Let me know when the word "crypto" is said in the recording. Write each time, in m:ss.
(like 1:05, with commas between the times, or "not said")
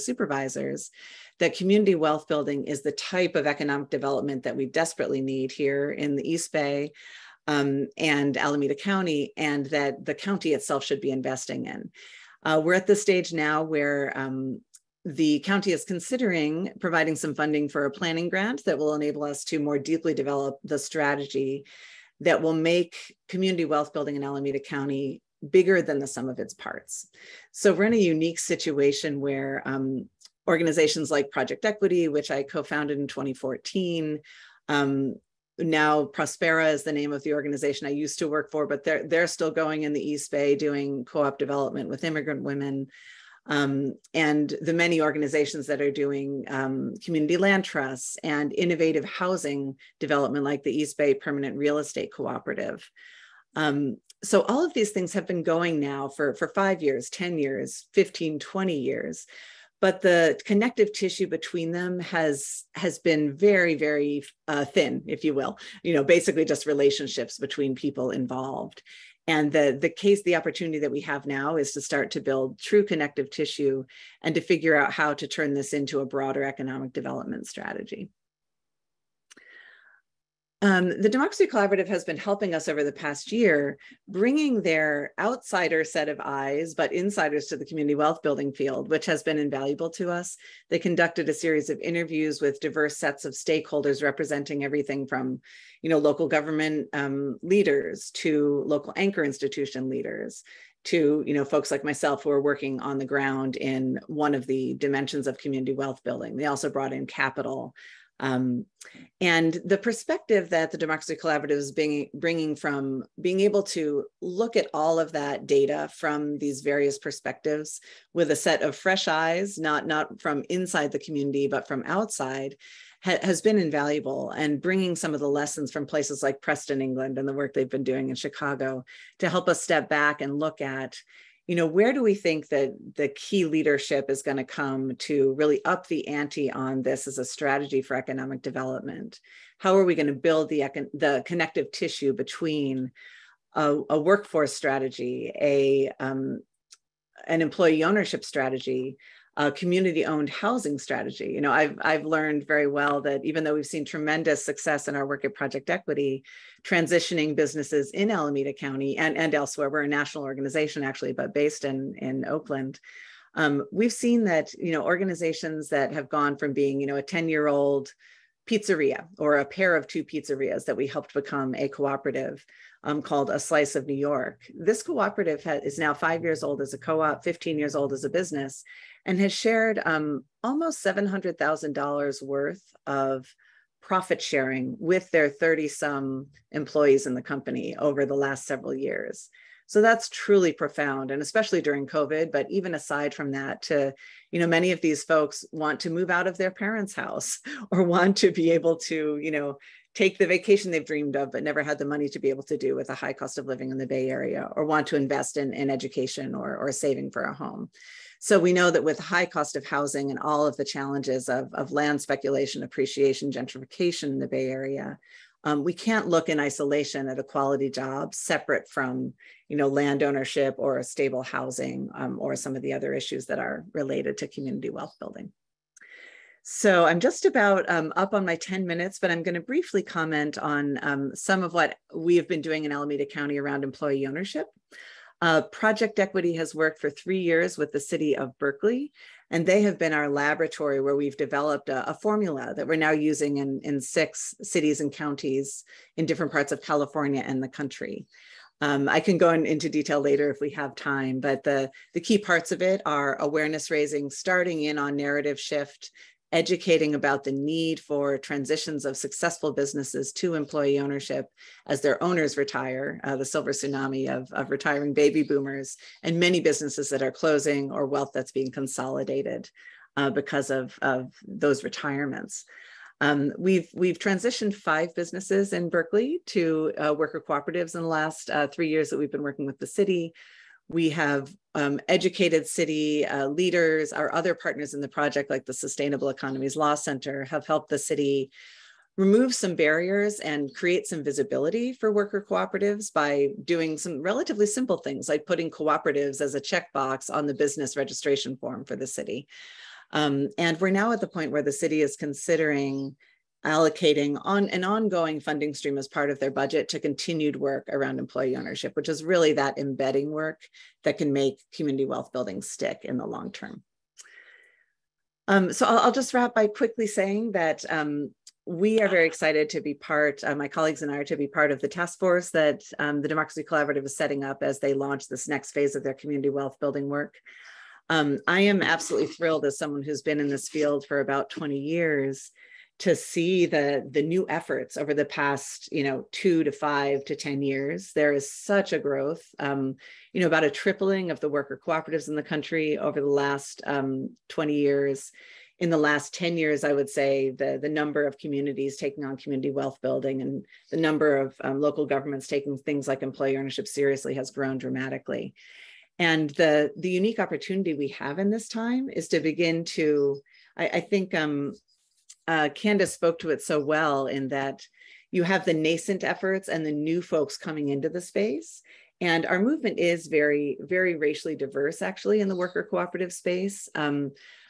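not said.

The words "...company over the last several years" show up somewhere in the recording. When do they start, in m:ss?
3:07.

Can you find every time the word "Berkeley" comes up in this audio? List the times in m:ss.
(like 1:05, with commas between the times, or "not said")
3:58, 4:35.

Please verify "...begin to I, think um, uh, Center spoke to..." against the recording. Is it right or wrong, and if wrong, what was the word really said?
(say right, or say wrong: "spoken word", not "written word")
wrong: "Candace", not "Center".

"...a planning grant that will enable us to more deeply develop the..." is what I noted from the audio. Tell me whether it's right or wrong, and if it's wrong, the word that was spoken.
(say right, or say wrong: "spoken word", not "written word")
right.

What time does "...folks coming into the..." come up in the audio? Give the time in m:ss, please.
6:07.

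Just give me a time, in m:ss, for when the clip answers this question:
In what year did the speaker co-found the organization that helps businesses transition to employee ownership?
0:33.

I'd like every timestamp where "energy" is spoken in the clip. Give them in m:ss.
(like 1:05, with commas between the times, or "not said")
not said.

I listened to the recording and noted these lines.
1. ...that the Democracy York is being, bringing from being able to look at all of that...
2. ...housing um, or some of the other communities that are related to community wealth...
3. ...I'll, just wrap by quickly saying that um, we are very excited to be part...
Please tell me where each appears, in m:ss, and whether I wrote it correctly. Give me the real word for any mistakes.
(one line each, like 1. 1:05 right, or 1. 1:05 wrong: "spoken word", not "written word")
1. 1:50 wrong: "Collaborative", not "York"
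2. 3:41 wrong: "issues", not "communities"
3. 5:15 right.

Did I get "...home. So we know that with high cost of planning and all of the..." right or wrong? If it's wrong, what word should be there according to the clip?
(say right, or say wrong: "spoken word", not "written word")
wrong: "housing", not "planning".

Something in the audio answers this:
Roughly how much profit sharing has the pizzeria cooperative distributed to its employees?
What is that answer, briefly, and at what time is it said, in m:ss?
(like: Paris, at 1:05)
$700,000, at 3:00.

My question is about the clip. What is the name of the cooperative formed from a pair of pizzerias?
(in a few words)
A Slice of New York.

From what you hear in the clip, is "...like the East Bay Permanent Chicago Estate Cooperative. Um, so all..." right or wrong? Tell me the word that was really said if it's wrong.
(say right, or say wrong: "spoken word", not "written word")
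wrong: "Real", not "Chicago".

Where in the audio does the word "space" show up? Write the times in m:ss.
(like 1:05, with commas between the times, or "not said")
6:07, 6:13.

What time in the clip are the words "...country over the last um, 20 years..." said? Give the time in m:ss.
5:42.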